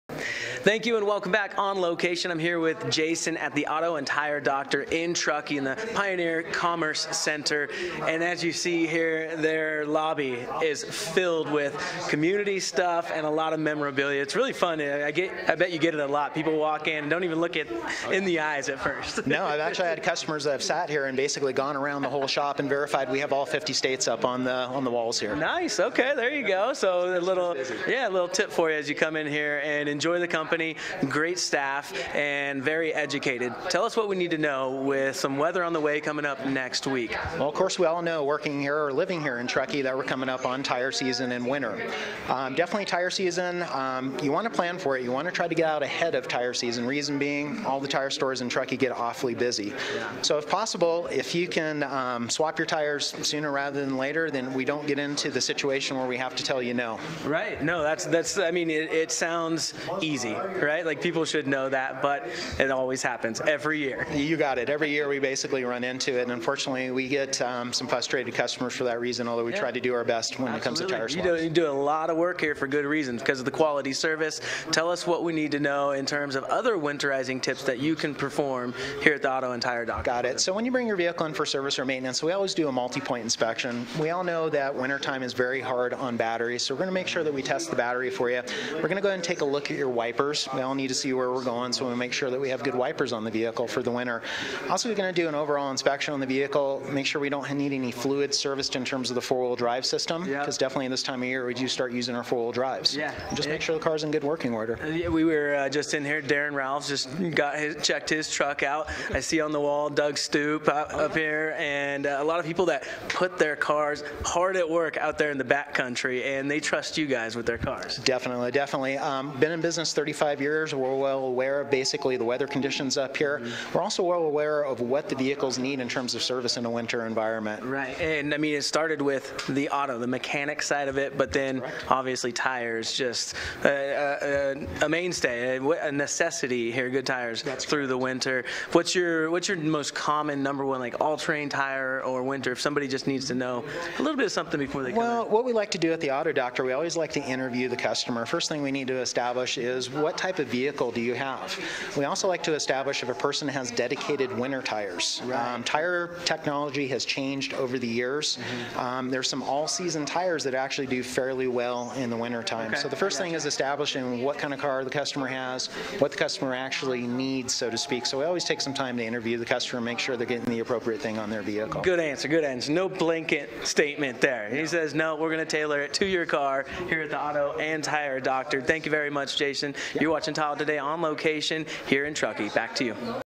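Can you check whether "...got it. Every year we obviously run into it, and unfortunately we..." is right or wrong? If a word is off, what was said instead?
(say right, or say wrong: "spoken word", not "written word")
wrong: "basically", not "obviously".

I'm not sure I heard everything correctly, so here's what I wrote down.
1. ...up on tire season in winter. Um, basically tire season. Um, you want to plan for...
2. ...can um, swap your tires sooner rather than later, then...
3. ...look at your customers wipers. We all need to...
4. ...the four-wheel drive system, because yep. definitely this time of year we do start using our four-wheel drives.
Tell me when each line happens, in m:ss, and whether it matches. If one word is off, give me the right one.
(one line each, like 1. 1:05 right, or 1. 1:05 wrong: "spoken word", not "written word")
1. 0:40 wrong: "definitely", not "basically"
2. 0:51 right
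3. 1:29 wrong: "wipers", not "customers"
4. 1:39 right.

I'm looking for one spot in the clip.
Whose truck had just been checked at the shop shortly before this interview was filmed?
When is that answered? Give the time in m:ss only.
1:46.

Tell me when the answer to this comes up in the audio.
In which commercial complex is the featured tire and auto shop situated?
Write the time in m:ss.
0:05.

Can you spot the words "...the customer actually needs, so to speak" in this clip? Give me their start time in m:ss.
2:46.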